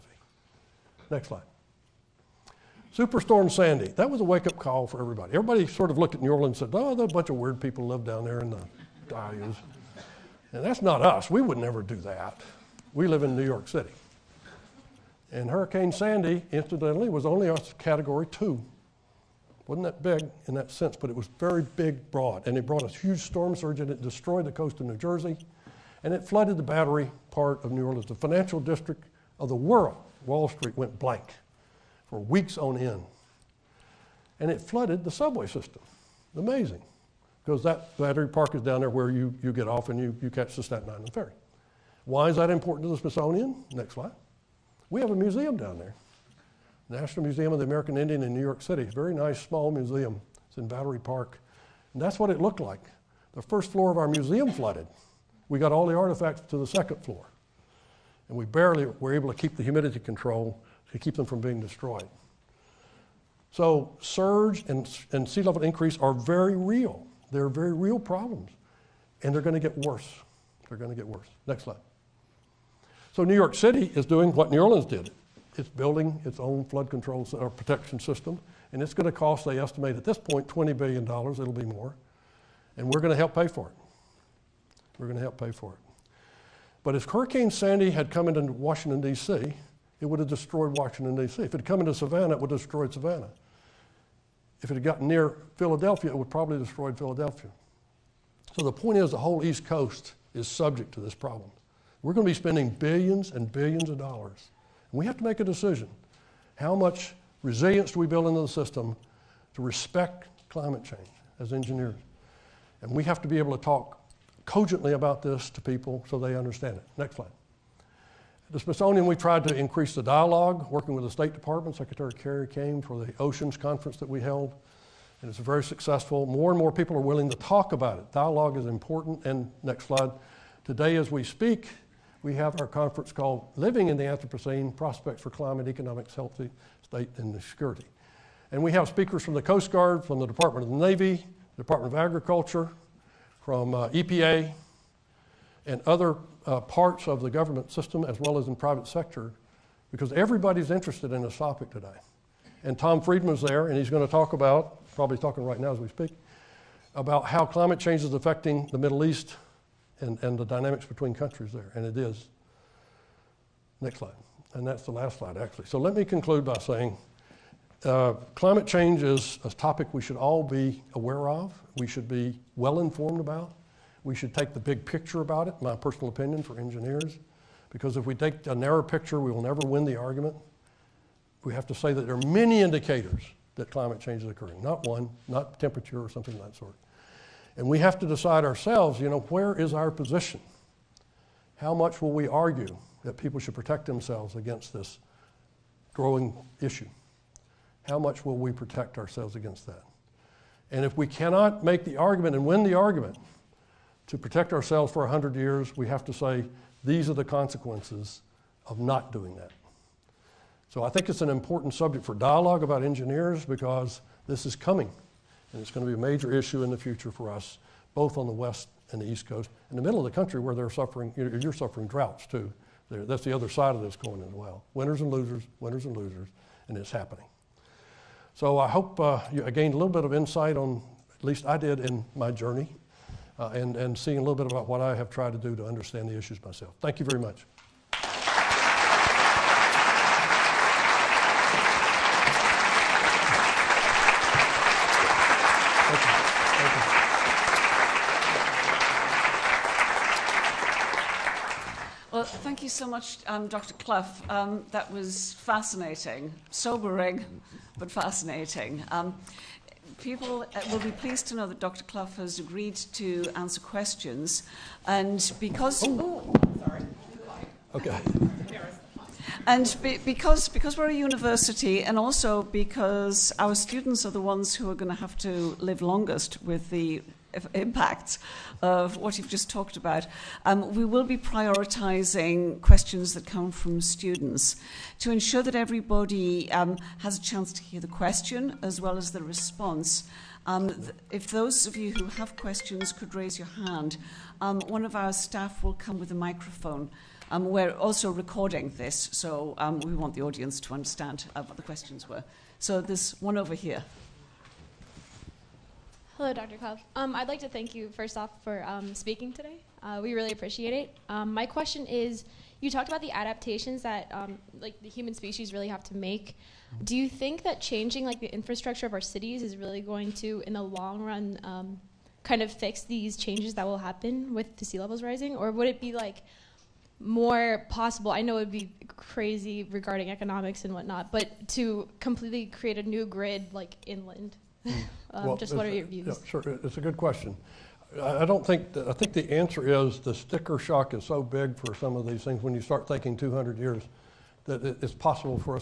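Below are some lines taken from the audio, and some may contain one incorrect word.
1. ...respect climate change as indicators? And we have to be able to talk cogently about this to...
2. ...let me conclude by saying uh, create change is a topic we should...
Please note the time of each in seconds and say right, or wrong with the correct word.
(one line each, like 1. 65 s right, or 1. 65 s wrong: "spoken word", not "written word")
1. 109 s wrong: "engineers", not "indicators"
2. 165 s wrong: "climate", not "create".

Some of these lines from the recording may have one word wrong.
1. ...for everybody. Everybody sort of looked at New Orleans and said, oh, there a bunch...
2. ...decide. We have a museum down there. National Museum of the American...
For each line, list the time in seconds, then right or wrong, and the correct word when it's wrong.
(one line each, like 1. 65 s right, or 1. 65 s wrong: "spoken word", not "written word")
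1. 4 s right
2. 43 s wrong: "slide", not "decide".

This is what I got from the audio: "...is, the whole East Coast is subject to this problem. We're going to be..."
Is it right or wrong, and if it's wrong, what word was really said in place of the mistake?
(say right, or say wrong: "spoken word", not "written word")
right.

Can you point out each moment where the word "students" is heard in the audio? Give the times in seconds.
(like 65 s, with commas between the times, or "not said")
273 s, 283 s.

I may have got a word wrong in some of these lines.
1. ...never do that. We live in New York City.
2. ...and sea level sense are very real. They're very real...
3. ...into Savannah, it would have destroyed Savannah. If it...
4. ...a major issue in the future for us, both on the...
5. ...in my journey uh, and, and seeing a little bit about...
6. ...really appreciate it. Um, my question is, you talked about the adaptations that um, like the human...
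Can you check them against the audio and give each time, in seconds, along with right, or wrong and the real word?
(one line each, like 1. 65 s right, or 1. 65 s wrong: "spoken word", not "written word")
1. 11 s right
2. 65 s wrong: "increase", not "sense"
3. 91 s right
4. 215 s right
5. 231 s right
6. 310 s right.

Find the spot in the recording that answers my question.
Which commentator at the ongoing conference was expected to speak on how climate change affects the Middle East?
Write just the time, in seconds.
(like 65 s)
152 s.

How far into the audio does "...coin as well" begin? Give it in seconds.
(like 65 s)
223 s.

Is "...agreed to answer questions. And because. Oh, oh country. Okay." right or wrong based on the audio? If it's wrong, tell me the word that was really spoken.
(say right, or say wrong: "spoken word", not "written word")
wrong: "sorry", not "country".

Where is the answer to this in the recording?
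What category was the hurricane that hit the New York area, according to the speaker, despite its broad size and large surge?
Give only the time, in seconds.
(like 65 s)
17 s.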